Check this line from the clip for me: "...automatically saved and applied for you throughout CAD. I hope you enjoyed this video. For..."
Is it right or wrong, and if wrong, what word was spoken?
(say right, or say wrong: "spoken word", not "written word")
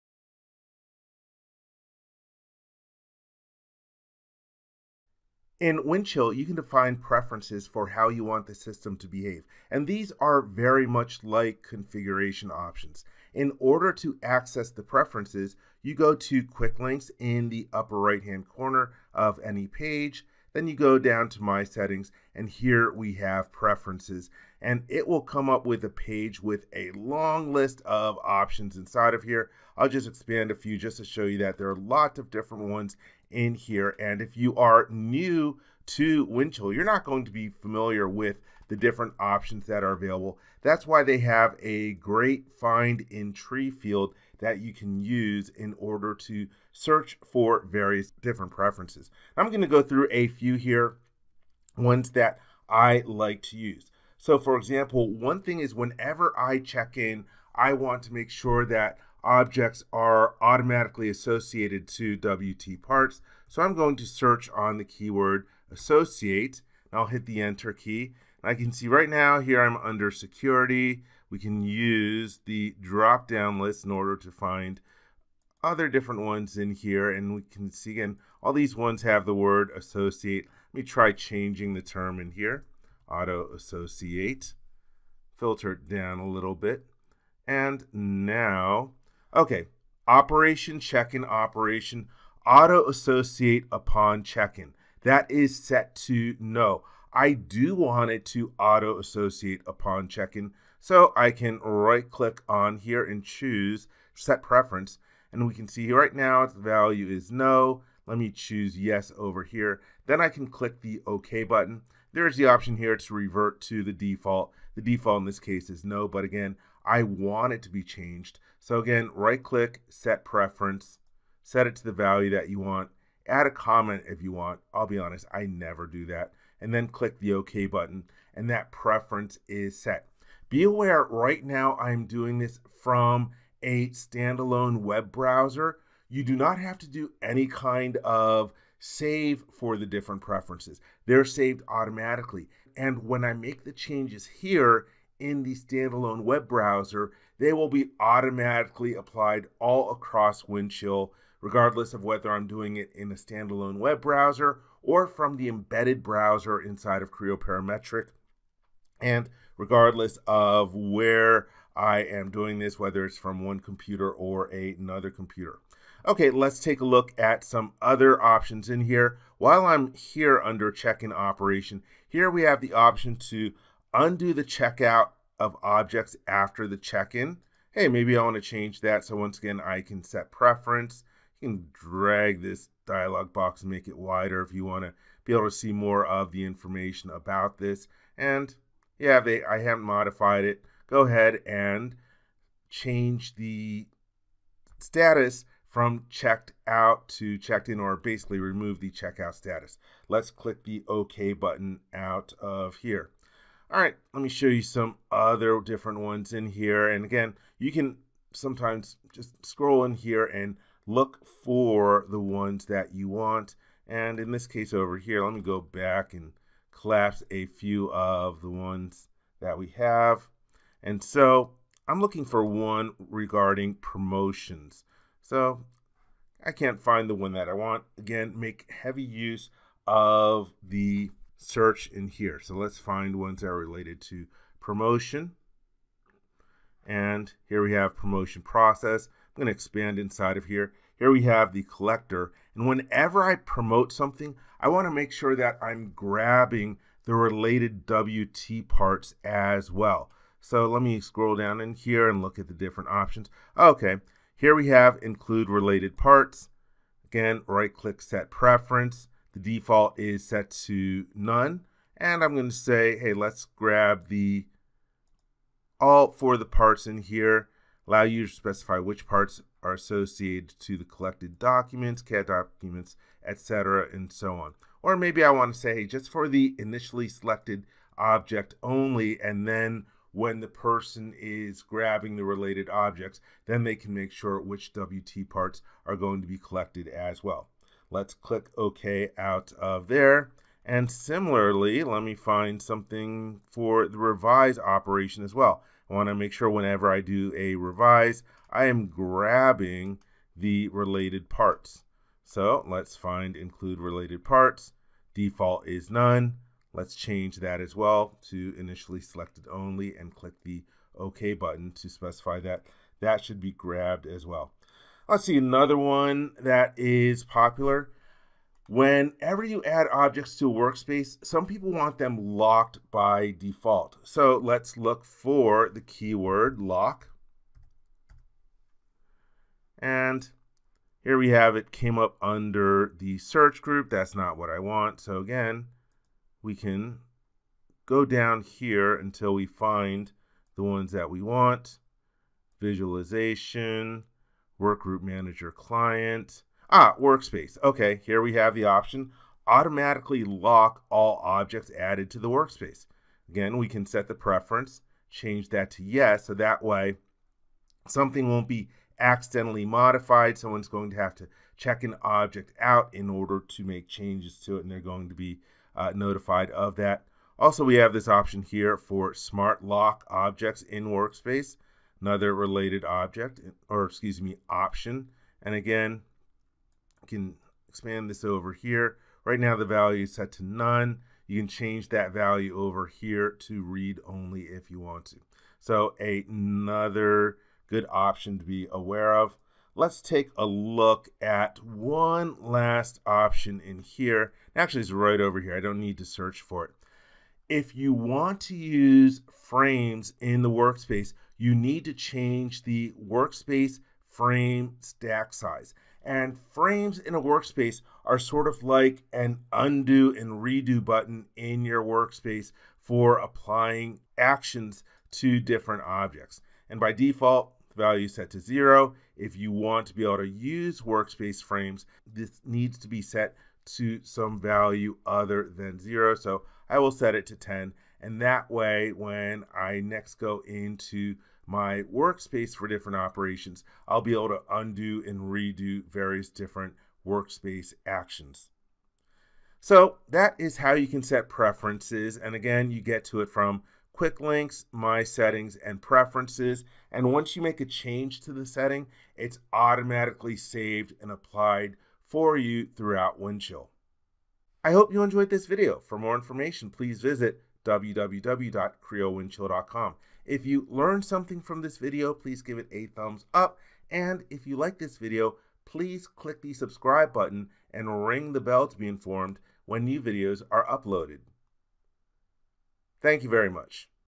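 wrong: "Windchill", not "CAD".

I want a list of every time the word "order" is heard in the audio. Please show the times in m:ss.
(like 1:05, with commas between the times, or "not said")
0:13, 0:45, 1:13, 6:03.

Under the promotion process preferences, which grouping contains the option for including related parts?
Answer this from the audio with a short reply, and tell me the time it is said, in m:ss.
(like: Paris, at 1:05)
the collector, at 4:01.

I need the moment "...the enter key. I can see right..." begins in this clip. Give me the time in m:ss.
1:07.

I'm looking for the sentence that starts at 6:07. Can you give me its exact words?
Also, we have this option here for smart lock objects in workspace, another related object, or excuse me, option.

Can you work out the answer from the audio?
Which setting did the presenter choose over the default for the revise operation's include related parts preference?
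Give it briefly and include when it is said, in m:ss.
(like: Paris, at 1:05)
initially selected only, at 5:08.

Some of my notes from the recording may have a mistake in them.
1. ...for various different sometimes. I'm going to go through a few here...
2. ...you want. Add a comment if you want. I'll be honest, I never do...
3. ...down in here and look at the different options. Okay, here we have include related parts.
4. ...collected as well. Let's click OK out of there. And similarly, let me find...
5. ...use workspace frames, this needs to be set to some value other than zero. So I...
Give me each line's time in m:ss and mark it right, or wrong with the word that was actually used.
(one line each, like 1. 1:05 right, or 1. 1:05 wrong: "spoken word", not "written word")
1. 0:47 wrong: "preferences", not "sometimes"
2. 2:02 right
3. 4:11 right
4. 4:46 right
5. 7:00 right.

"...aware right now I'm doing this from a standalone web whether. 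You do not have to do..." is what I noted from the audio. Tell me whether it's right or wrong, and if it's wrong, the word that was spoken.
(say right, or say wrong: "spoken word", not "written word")
wrong: "browser", not "whether".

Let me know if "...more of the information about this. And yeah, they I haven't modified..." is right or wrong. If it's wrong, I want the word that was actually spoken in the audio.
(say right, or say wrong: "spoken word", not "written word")
right.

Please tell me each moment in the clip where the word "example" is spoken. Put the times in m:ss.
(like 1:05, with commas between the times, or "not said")
0:54.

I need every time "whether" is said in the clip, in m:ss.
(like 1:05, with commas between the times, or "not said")
2:32, 2:42.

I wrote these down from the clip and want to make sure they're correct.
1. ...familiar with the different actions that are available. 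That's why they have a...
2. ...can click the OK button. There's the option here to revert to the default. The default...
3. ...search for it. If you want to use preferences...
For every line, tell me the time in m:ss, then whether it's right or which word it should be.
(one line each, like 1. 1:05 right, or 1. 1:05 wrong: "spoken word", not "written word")
1. 0:37 wrong: "options", not "actions"
2. 1:50 right
3. 6:36 wrong: "frames", not "preferences".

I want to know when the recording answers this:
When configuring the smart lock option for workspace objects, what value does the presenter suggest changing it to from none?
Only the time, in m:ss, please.
6:23.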